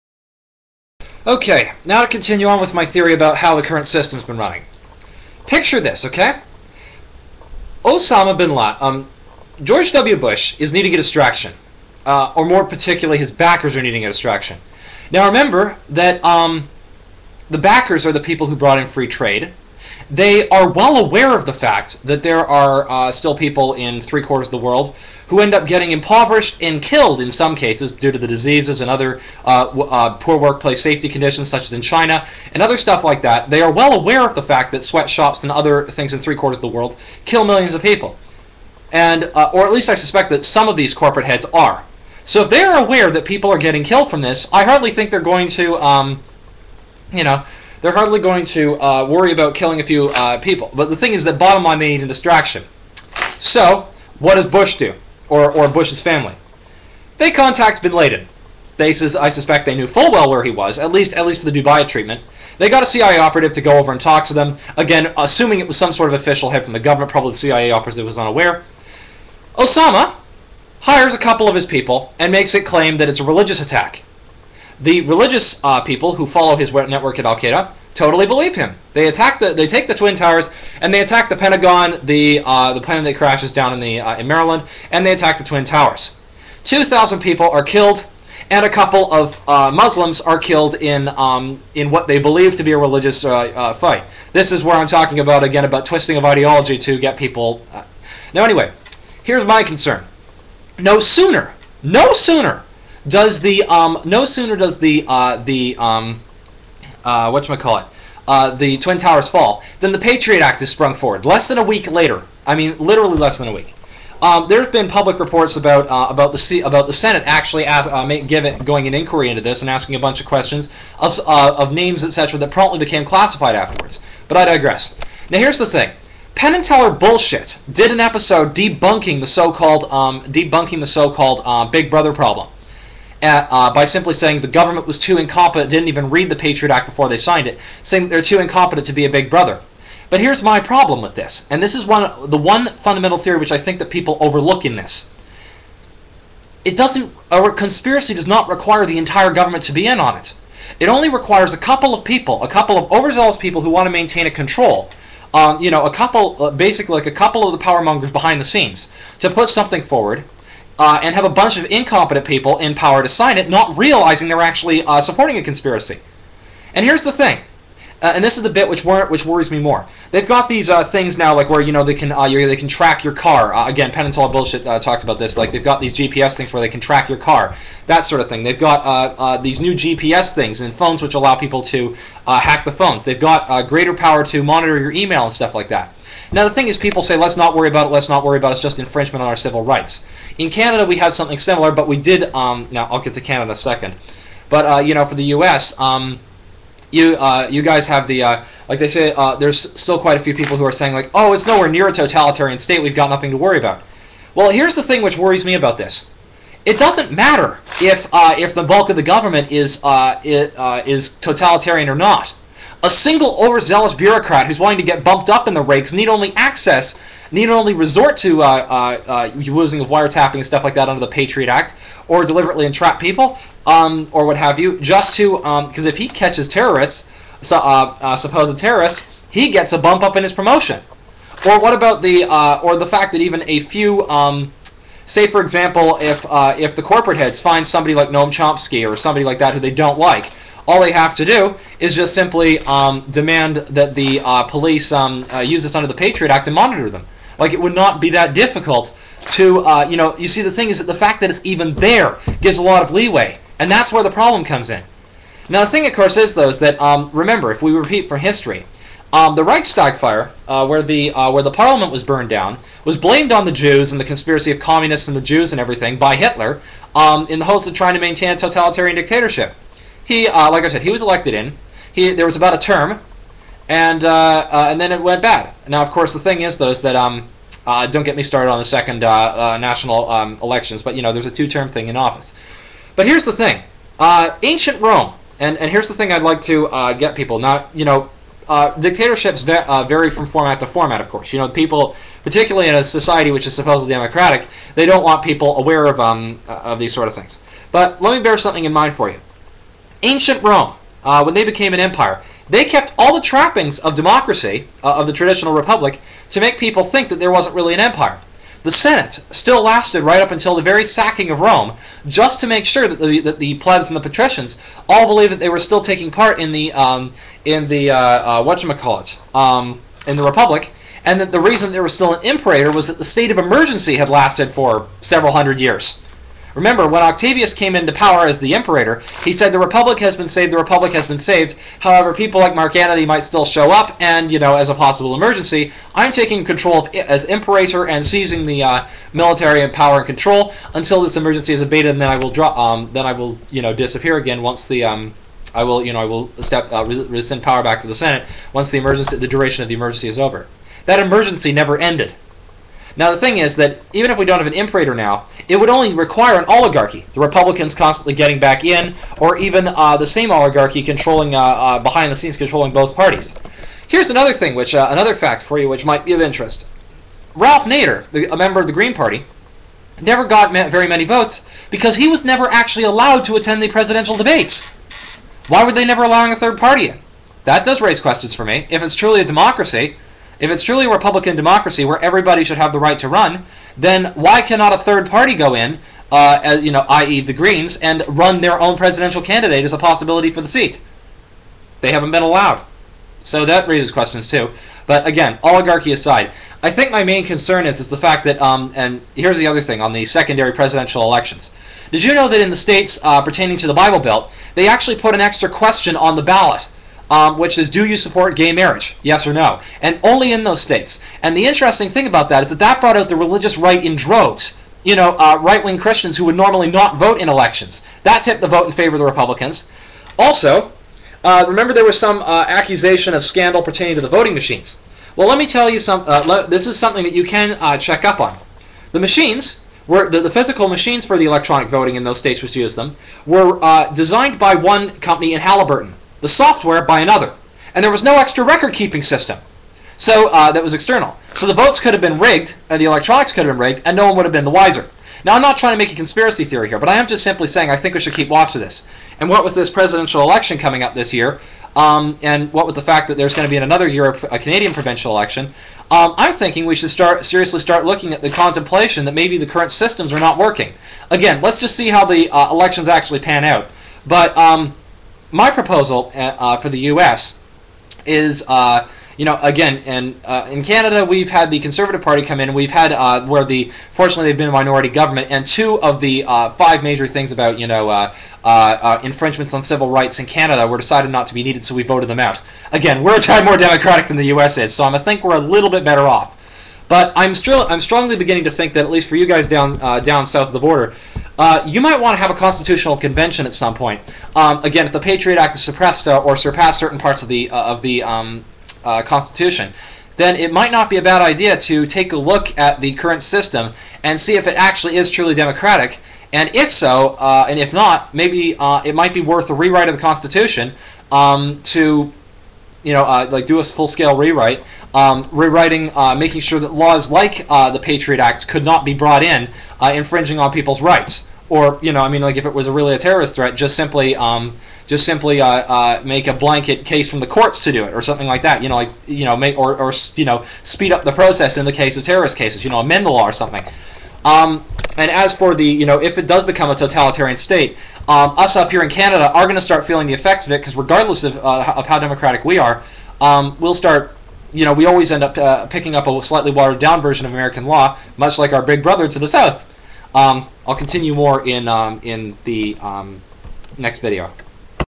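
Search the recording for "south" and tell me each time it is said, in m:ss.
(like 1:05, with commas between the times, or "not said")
8:10, 9:09.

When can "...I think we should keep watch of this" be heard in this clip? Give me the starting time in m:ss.
7:27.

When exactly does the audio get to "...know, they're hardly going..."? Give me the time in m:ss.
0:47.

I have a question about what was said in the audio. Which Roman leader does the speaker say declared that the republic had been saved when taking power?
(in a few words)
Octavius.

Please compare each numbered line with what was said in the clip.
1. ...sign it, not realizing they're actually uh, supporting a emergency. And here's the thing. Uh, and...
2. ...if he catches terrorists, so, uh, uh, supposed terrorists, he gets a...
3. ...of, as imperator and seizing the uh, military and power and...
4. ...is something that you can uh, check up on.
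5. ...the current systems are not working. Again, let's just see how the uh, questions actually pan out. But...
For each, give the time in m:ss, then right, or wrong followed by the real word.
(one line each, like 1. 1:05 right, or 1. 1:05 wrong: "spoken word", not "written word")
1. 2:43 wrong: "conspiracy", not "emergency"
2. 3:45 right
3. 5:36 right
4. 7:06 right
5. 7:39 wrong: "elections", not "questions".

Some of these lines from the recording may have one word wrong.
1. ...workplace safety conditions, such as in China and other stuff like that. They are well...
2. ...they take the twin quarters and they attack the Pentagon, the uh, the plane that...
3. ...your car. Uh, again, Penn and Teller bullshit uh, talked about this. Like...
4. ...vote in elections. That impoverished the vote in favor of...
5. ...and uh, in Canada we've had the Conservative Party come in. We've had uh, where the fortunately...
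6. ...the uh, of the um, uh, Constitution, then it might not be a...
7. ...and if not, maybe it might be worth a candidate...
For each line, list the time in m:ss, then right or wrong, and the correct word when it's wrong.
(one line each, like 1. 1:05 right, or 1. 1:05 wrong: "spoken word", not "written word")
1. 0:30 right
2. 1:19 wrong: "towers", not "quarters"
3. 2:53 right
4. 6:56 wrong: "tipped", not "impoverished"
5. 7:49 right
6. 8:17 right
7. 8:27 wrong: "rewrite", not "candidate".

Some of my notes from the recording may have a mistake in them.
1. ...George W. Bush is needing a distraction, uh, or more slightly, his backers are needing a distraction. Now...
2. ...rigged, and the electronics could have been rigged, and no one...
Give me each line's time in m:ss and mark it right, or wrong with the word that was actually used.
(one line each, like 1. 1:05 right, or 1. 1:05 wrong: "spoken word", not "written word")
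1. 0:09 wrong: "particularly", not "slightly"
2. 7:22 right.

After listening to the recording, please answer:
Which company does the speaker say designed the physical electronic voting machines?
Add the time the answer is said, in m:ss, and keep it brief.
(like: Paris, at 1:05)
Halliburton, at 7:15.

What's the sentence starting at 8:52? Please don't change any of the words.
You know, amend the law or something.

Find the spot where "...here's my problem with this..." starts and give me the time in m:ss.
2:20.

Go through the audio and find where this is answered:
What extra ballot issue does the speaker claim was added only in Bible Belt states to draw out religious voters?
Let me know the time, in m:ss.
6:48.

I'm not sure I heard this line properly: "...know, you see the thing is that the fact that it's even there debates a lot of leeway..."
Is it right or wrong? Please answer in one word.
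wrong.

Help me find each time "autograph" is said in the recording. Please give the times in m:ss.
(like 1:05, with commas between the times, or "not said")
not said.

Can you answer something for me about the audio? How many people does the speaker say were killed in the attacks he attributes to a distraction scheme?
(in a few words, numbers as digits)
2000.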